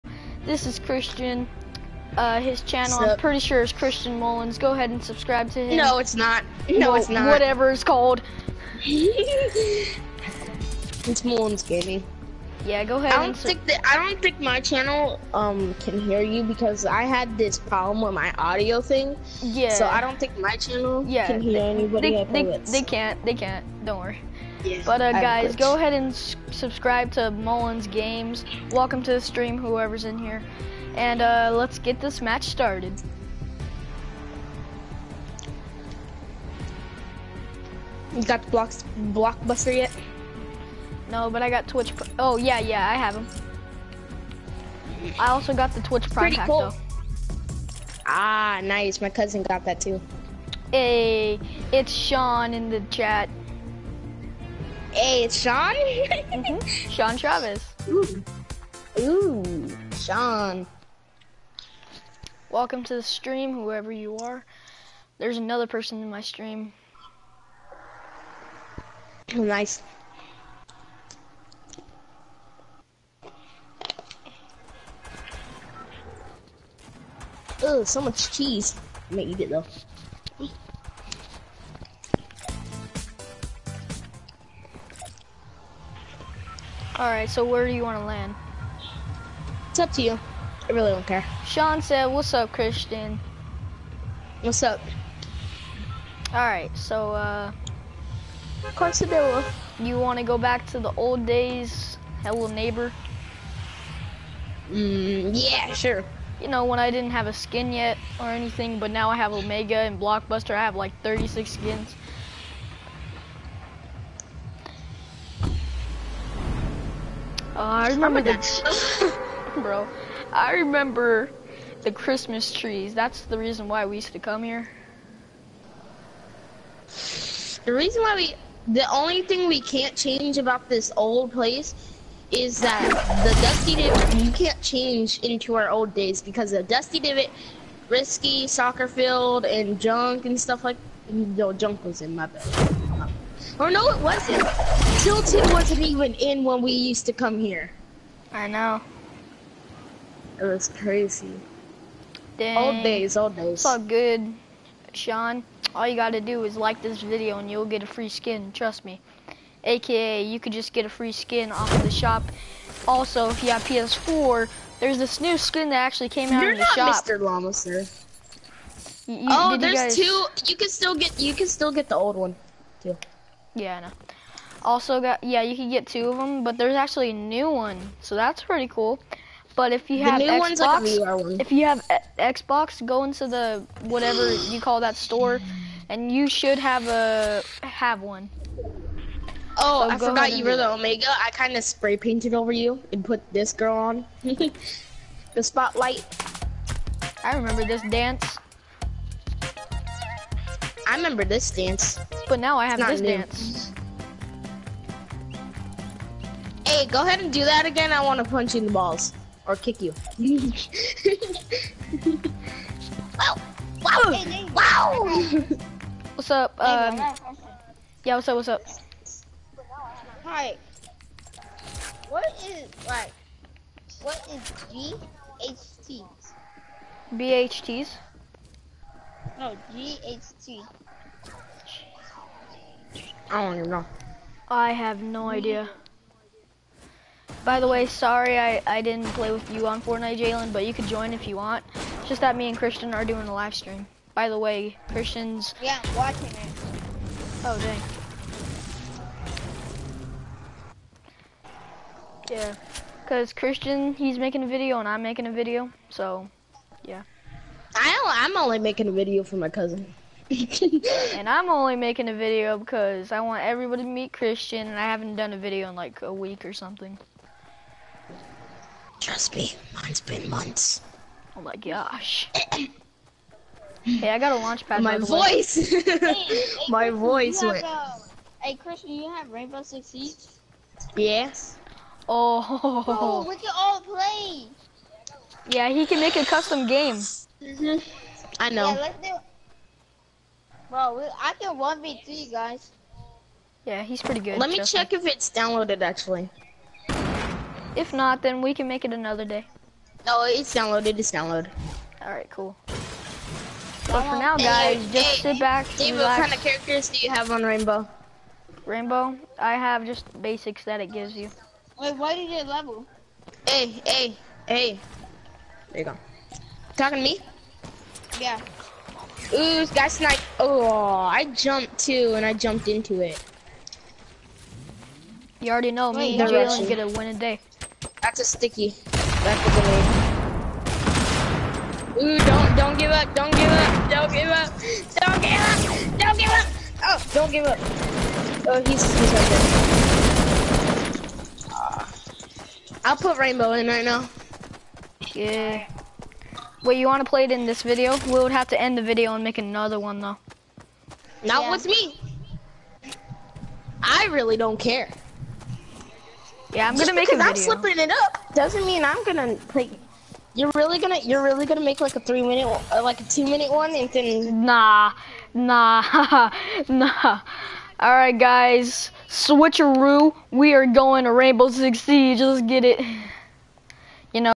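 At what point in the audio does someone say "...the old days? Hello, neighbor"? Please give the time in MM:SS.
01:40.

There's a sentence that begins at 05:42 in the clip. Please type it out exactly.
I'll put rainbow in right now.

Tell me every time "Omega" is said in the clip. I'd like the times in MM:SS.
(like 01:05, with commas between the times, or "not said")
01:49, 03:10.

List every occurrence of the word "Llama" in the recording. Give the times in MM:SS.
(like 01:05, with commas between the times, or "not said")
02:47.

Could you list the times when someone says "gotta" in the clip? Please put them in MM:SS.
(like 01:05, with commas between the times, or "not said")
02:35.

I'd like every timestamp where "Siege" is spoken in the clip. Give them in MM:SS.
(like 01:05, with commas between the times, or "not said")
04:39, 06:11.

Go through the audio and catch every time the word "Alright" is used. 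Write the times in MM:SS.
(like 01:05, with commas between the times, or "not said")
01:26, 01:36, 06:07.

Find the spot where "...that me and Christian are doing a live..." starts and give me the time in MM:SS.
04:02.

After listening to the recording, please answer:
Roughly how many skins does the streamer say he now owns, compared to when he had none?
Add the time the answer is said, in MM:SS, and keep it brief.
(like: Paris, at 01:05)
36, at 01:51.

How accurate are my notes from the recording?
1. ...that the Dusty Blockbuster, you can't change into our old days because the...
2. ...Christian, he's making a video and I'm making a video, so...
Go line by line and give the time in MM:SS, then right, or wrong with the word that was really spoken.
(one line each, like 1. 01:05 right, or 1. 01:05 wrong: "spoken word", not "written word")
1. 02:12 wrong: "Divot", not "Blockbuster"
2. 04:13 right.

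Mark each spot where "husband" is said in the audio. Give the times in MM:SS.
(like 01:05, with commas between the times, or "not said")
not said.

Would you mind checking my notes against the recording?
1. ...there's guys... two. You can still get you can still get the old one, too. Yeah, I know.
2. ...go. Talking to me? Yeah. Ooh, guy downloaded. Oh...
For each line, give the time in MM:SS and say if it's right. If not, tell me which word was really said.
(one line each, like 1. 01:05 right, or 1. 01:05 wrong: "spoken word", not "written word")
1. 02:49 right
2. 05:15 wrong: "sniped", not "downloaded".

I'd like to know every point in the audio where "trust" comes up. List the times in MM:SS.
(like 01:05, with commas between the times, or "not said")
02:38, 04:29.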